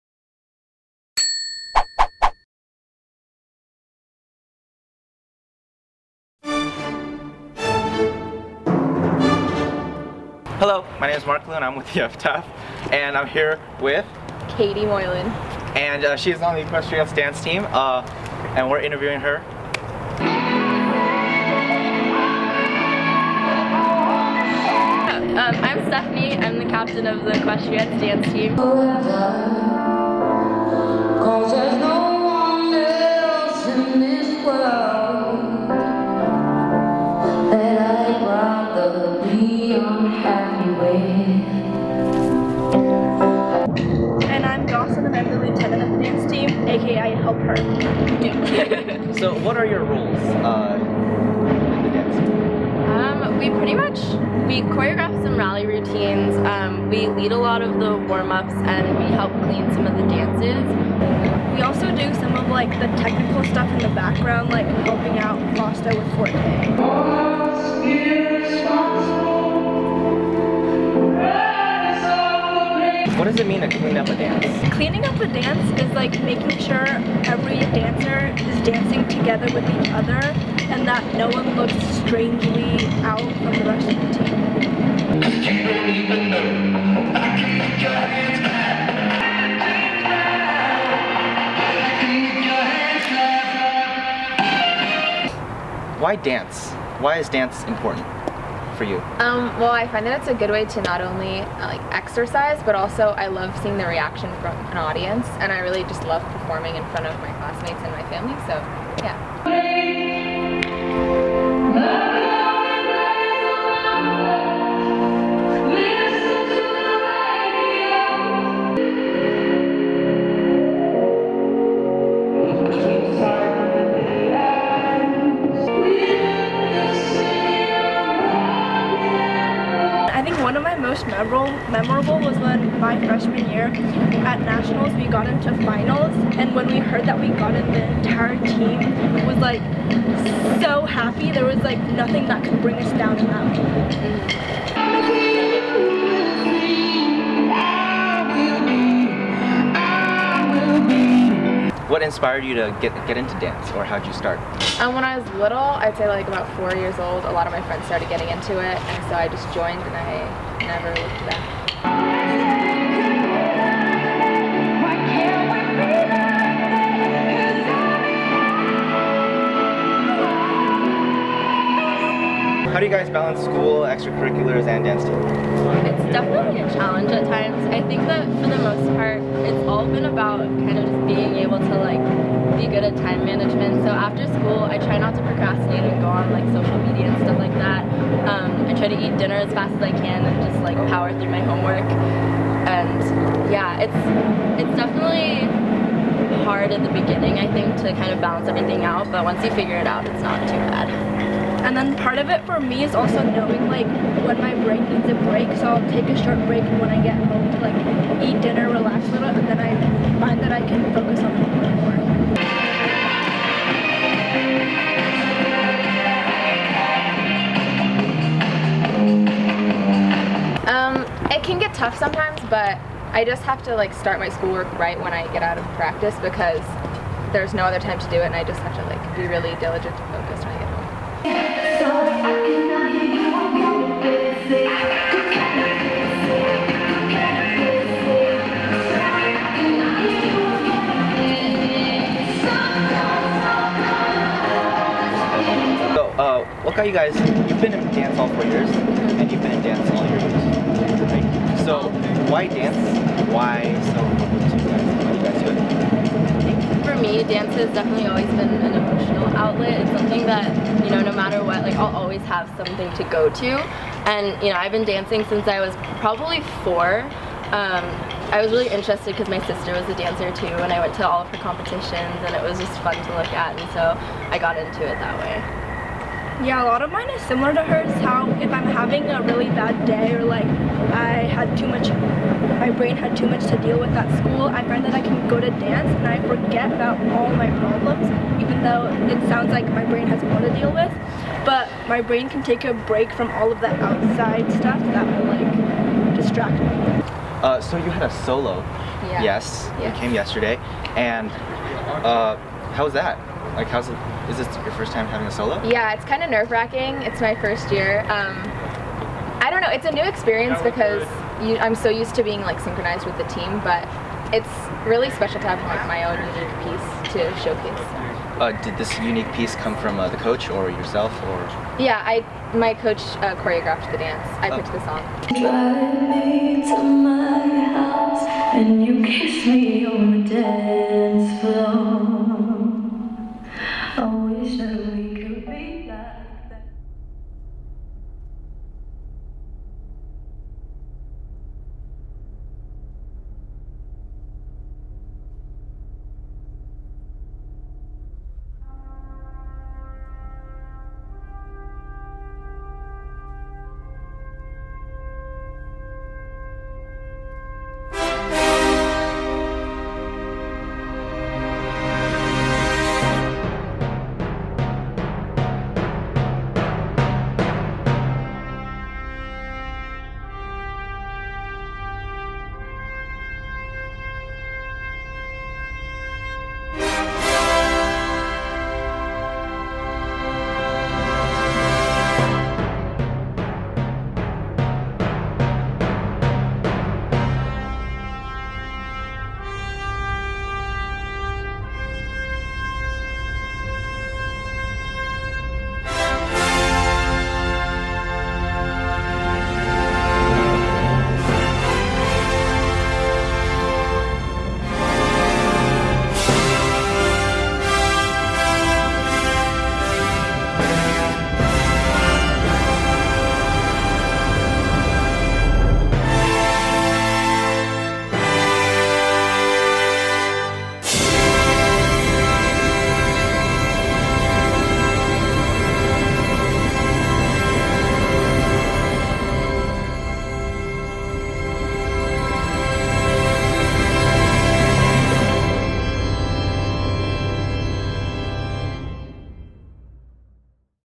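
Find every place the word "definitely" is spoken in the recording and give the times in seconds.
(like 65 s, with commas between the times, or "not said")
176 s, 194 s, 257 s.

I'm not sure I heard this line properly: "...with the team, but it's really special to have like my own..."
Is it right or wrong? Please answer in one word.
right.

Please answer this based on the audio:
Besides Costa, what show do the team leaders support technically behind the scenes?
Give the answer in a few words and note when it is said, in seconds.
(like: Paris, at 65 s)
Forte, at 66 s.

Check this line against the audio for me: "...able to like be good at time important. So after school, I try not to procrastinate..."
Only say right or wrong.
wrong.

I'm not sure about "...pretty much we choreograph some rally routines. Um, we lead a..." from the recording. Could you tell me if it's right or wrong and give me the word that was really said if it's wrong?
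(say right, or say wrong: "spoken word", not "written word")
right.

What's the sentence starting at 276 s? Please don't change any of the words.
Yeah, a lot of mine is similar to hers.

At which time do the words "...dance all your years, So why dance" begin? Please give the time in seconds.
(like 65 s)
249 s.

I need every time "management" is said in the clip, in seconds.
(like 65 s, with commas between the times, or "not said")
183 s.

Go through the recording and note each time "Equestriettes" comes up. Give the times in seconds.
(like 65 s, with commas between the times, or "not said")
16 s, 27 s.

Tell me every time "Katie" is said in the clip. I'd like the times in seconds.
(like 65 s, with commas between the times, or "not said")
14 s.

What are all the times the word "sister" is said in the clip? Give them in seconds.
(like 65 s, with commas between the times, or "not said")
269 s.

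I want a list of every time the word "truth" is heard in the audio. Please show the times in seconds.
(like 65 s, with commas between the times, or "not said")
not said.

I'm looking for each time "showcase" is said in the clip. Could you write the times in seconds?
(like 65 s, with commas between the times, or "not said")
317 s.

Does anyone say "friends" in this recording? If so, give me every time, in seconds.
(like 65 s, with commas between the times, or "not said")
157 s.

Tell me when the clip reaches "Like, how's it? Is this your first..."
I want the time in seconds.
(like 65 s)
303 s.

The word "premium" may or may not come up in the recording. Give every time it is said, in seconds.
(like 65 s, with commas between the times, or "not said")
not said.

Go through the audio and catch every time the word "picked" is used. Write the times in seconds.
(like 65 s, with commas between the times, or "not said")
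324 s.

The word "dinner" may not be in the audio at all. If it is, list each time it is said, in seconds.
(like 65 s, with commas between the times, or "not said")
189 s, 208 s.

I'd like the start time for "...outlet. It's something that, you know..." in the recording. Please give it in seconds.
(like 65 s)
259 s.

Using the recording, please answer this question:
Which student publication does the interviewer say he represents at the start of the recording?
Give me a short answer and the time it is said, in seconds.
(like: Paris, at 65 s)
the Epitaph, at 11 s.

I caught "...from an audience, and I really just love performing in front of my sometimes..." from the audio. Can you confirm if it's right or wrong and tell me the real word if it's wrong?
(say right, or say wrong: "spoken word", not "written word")
wrong: "classmates", not "sometimes".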